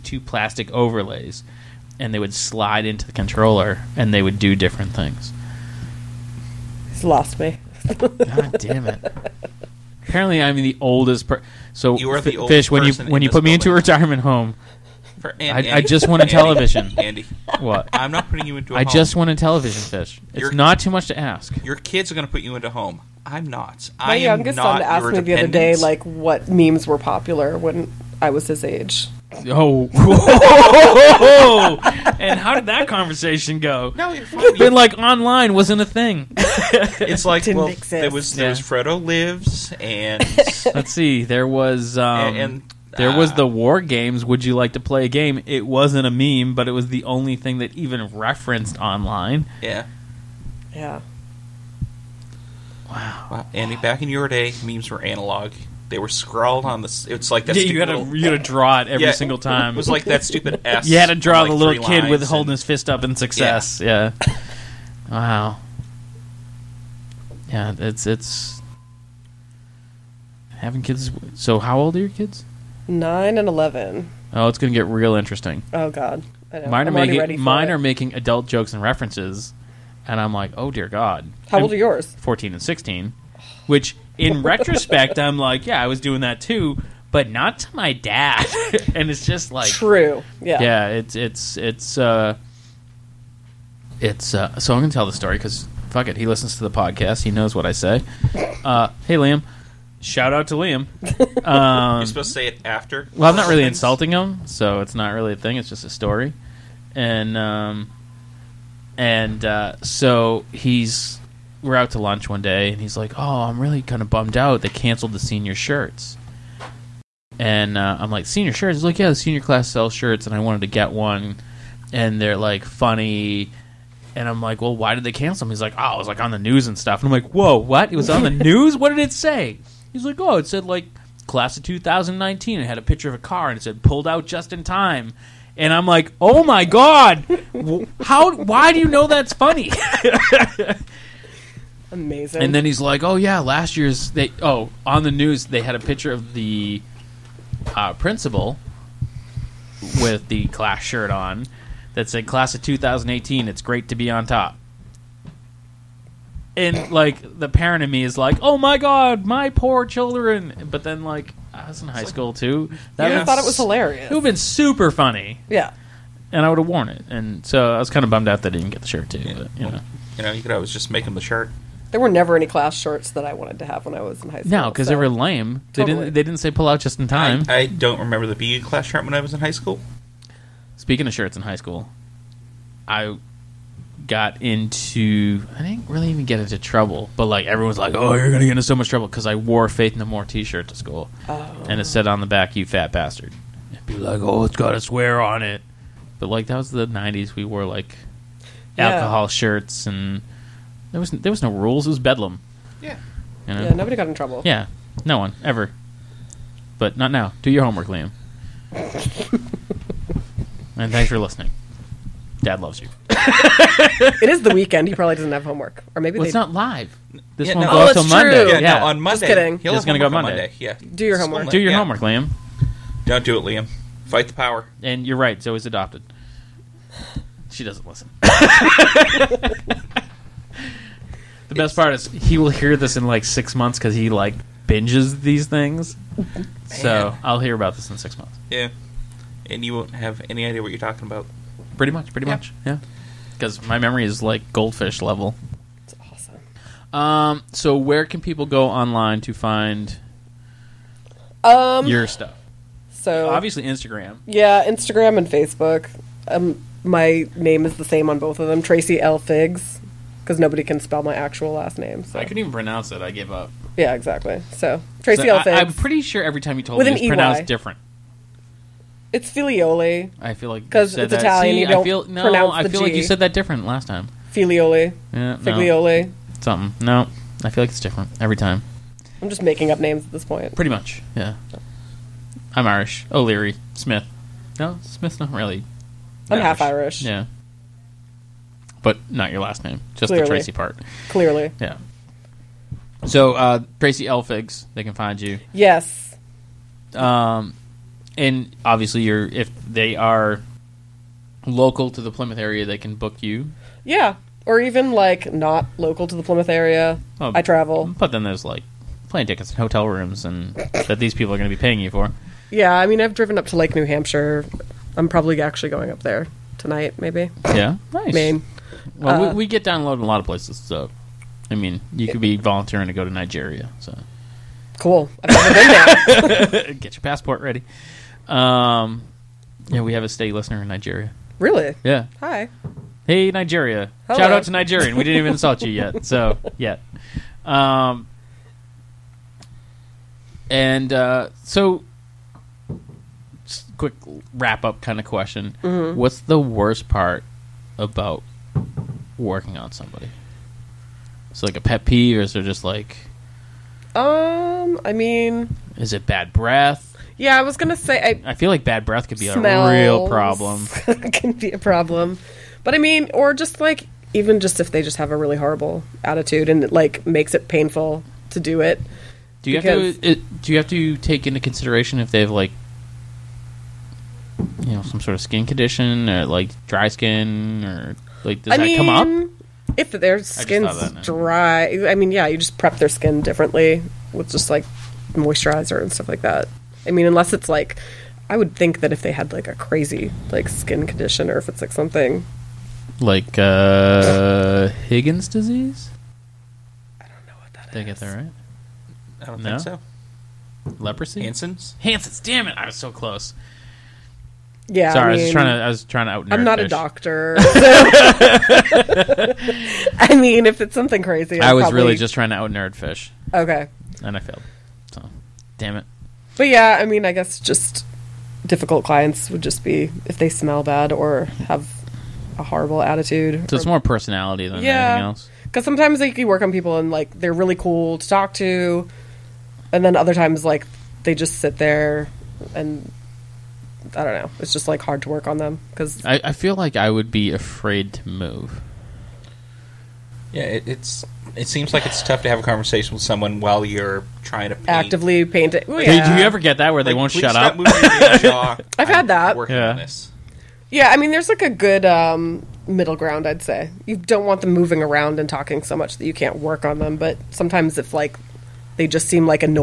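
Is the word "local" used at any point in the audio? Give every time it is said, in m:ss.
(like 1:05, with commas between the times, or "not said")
5:01, 5:05.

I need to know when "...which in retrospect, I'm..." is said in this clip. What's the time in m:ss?
1:23.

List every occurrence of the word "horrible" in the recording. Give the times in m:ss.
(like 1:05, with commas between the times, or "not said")
6:05, 7:02.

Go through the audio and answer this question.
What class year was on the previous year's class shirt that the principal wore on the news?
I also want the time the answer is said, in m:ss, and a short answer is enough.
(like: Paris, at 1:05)
2018, at 2:32.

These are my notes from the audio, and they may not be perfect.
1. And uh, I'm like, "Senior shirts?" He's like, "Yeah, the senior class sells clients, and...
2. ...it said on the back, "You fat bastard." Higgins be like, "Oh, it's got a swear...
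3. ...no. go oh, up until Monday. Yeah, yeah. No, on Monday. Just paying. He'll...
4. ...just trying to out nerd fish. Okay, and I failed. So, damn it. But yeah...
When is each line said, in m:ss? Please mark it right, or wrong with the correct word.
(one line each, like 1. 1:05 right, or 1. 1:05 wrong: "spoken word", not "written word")
1. 1:57 wrong: "shirts", not "clients"
2. 3:11 wrong: "And", not "Higgins"
3. 3:37 wrong: "kidding", not "paying"
4. 6:51 right.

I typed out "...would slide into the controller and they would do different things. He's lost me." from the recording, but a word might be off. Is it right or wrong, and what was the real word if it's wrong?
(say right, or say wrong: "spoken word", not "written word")
right.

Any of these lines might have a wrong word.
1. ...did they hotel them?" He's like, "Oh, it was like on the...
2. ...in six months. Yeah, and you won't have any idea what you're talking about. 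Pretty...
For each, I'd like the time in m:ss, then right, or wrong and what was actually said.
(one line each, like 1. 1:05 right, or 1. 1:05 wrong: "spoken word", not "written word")
1. 2:04 wrong: "cancel", not "hotel"
2. 3:57 right.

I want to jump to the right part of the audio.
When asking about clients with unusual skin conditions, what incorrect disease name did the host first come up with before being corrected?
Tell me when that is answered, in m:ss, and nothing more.
6:34.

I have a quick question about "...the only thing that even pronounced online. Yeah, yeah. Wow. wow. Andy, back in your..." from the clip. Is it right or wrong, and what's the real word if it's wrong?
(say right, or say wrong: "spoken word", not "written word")
wrong: "referenced", not "pronounced".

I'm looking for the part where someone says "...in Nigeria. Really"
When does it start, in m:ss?
5:30.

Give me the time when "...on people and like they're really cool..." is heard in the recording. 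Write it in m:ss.
7:06.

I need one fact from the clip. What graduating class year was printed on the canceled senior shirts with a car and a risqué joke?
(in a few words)
2019.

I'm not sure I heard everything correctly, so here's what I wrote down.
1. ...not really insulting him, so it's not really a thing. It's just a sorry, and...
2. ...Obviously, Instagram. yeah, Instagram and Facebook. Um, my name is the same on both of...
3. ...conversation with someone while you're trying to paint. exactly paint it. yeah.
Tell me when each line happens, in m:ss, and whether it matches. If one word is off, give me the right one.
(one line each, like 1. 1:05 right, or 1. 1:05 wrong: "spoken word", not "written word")
1. 1:43 wrong: "story", not "sorry"
2. 4:13 right
3. 7:22 wrong: "actively", not "exactly".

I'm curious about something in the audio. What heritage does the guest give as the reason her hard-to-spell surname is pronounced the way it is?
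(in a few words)
Italian.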